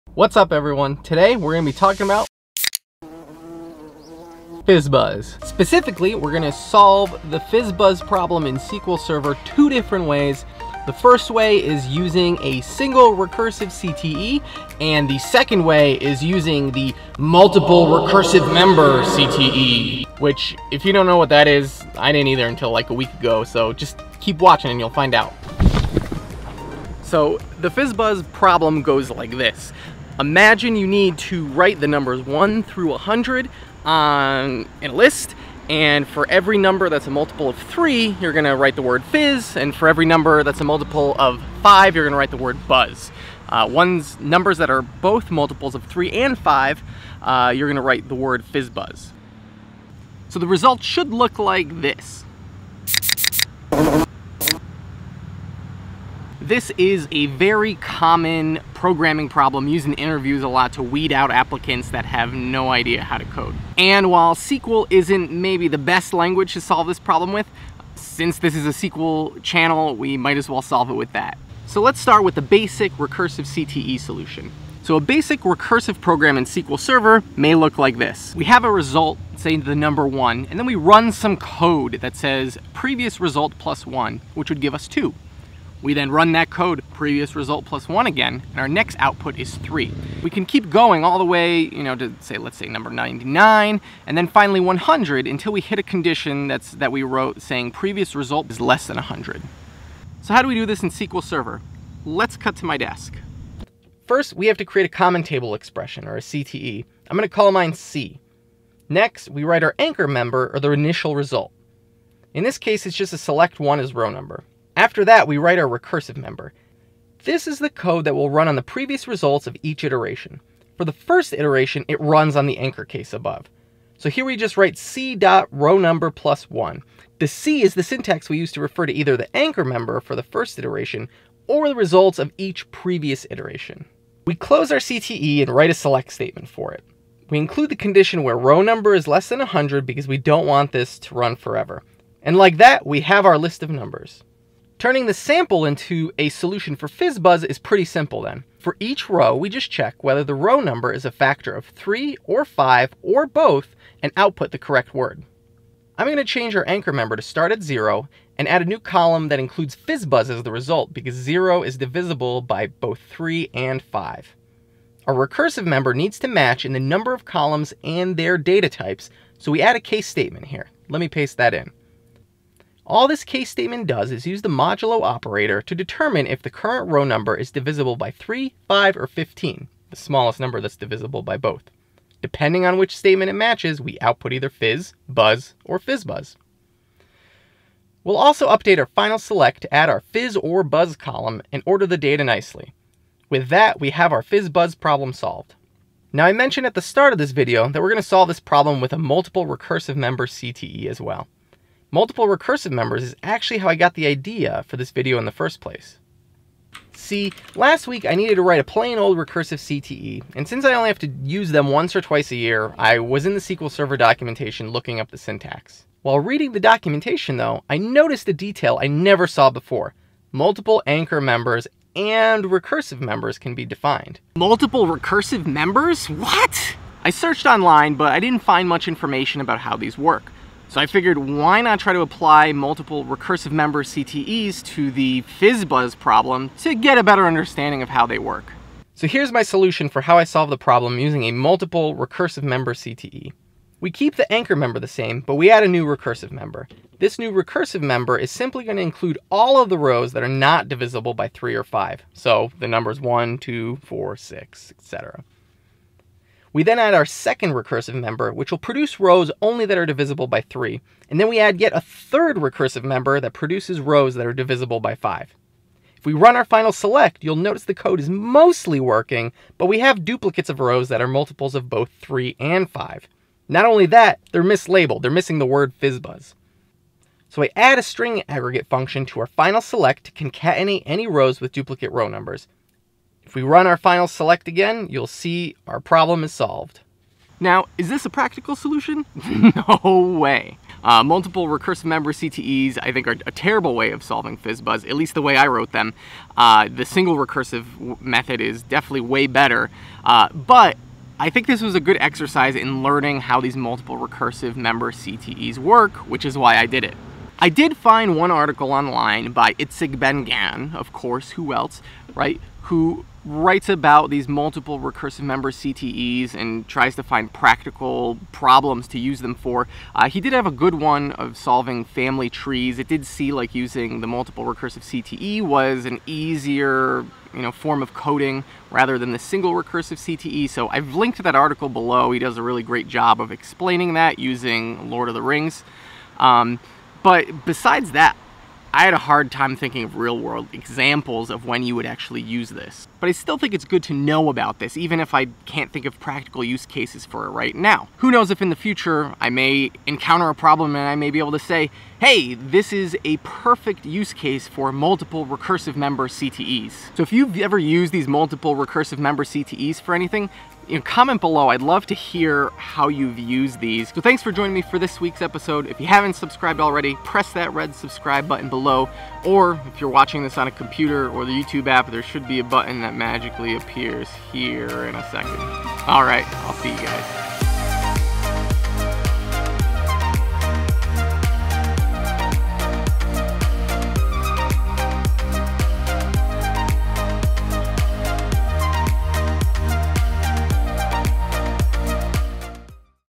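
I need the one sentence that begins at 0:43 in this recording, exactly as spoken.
Uh, ones numbers that are both multiples of 3 and 5, uh, you're going to write the word fizz buzz.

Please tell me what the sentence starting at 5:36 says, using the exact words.
Um, but besides that, I had a hard time thinking of real world examples of when you would actually use this.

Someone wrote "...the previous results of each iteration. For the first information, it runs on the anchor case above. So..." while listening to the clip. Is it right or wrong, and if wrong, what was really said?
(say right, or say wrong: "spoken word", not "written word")
wrong: "iteration", not "information".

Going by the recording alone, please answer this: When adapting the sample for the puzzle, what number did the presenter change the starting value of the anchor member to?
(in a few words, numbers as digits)
0.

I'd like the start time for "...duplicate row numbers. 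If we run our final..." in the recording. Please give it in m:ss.
4:41.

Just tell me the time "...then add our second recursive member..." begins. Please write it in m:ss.
4:16.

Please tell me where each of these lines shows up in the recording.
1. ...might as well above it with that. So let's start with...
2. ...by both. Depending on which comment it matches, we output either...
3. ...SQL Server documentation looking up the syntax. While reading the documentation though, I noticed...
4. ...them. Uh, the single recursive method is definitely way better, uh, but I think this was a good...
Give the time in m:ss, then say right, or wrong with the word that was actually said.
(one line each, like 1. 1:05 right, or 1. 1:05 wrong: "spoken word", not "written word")
1. 1:10 wrong: "solve", not "above"
2. 3:01 wrong: "statement", not "comment"
3. 3:33 right
4. 4:55 right.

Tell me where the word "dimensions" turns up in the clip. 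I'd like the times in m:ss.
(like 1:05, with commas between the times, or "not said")
not said.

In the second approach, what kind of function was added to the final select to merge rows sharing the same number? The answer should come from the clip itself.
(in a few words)
string aggregate function.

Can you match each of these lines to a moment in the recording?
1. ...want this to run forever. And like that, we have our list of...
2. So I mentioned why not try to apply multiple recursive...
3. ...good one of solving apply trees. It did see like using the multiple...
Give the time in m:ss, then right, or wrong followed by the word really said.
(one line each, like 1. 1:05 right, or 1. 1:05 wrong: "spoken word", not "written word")
1. 2:20 right
2. 3:50 wrong: "figured", not "mentioned"
3. 5:20 wrong: "family", not "apply".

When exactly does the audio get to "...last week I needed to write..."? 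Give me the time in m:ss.
3:27.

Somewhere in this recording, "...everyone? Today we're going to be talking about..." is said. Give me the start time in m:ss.
0:00.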